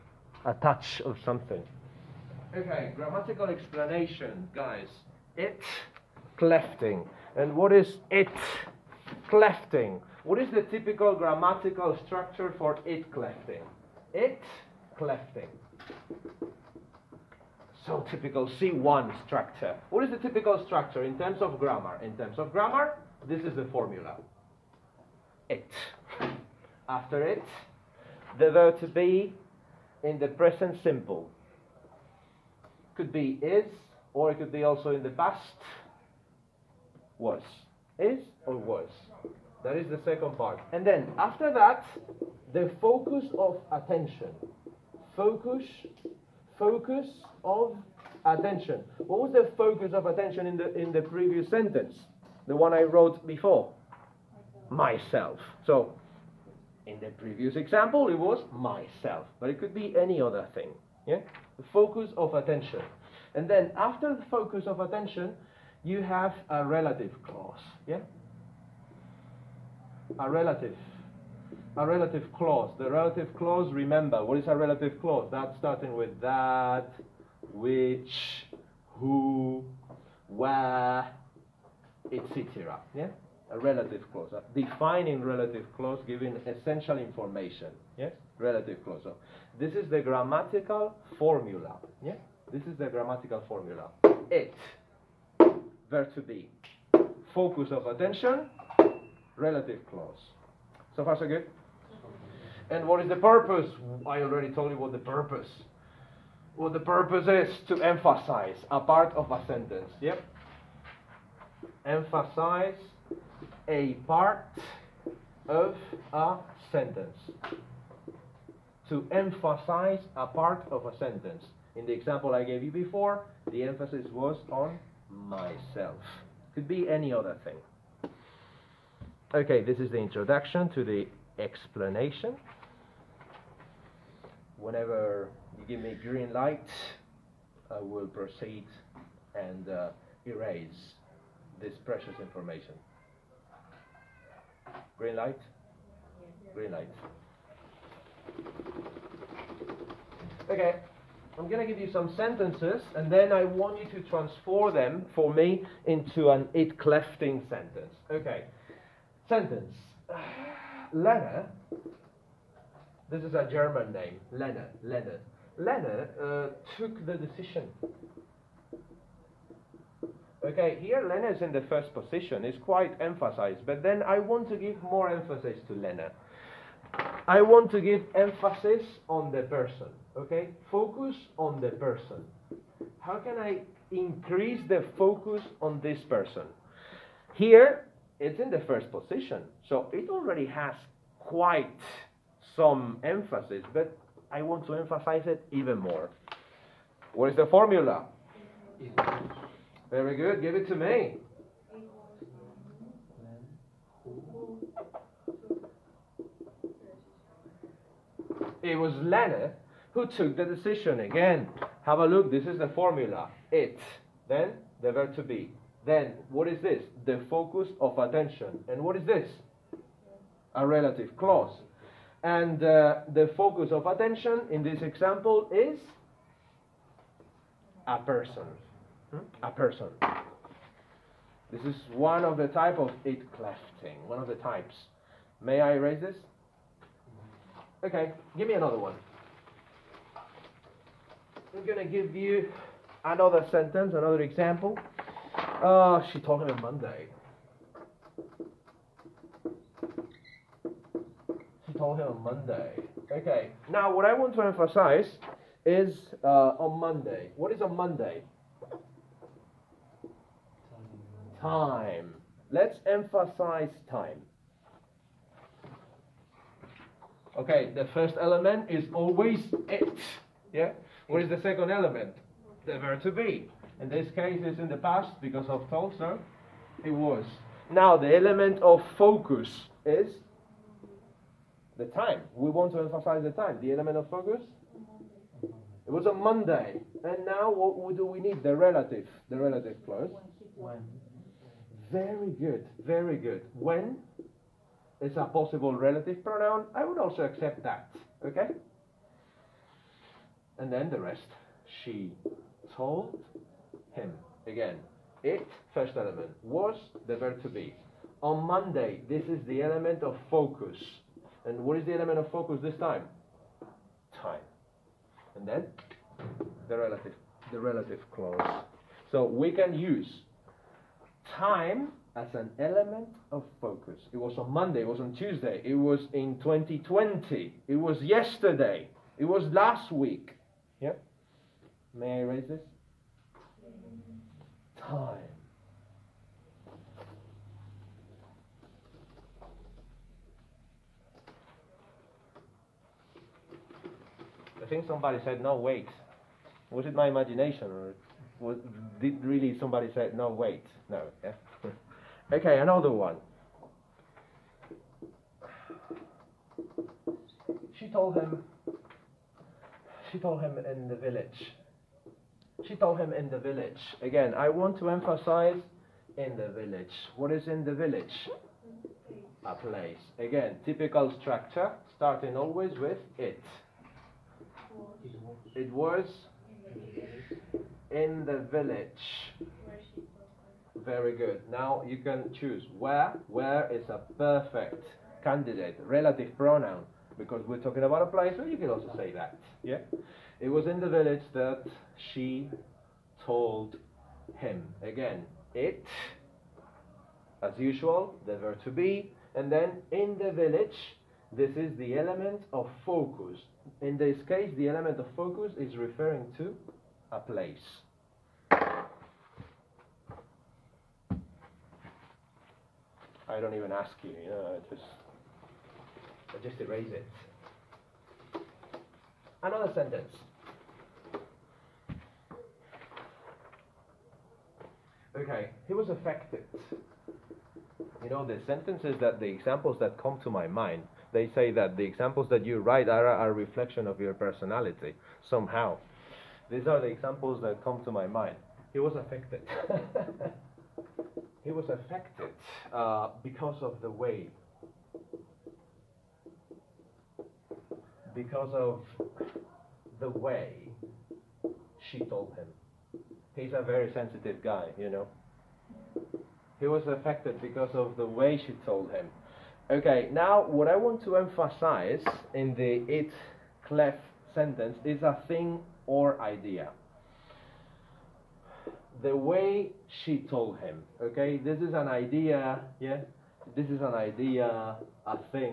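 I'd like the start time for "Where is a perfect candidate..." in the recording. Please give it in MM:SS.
06:23.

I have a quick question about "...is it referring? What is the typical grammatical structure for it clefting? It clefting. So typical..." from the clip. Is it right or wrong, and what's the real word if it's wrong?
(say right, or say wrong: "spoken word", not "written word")
wrong: "clefting", not "referring".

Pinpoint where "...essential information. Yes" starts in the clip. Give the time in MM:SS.
01:26.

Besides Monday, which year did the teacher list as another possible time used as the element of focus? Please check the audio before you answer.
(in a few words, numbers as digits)
2020.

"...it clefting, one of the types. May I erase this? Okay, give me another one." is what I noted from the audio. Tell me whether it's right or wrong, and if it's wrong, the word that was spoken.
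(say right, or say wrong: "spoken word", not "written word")
right.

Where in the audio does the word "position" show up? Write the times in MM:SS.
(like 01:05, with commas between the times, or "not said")
02:51, 03:08.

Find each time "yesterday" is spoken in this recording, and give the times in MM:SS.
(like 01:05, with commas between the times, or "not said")
05:28.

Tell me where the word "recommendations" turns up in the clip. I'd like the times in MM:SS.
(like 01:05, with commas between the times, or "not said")
not said.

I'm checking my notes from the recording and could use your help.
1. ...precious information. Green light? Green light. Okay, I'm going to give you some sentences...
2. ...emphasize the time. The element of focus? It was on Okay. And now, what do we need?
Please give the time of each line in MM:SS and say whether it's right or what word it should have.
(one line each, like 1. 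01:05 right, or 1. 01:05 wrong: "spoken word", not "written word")
1. 02:21 right
2. 04:42 wrong: "Monday", not "Okay".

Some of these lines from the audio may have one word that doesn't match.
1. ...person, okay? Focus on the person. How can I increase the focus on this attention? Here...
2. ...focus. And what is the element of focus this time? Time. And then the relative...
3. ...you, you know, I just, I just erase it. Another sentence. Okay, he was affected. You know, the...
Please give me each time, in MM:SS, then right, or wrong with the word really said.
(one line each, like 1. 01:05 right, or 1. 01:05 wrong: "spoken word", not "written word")
1. 02:59 wrong: "person", not "attention"
2. 05:10 right
3. 06:54 right.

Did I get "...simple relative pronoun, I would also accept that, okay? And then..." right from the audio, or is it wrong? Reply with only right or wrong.
wrong.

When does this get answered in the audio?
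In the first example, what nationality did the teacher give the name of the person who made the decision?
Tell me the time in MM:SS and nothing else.
02:43.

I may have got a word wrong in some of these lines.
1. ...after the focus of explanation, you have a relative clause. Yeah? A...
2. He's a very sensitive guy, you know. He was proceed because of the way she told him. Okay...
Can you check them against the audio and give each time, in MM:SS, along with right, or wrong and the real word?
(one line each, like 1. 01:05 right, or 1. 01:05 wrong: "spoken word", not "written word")
1. 01:03 wrong: "attention", not "explanation"
2. 07:33 wrong: "affected", not "proceed".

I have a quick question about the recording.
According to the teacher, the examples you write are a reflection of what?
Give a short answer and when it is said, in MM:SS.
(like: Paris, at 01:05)
Your personality, at 07:13.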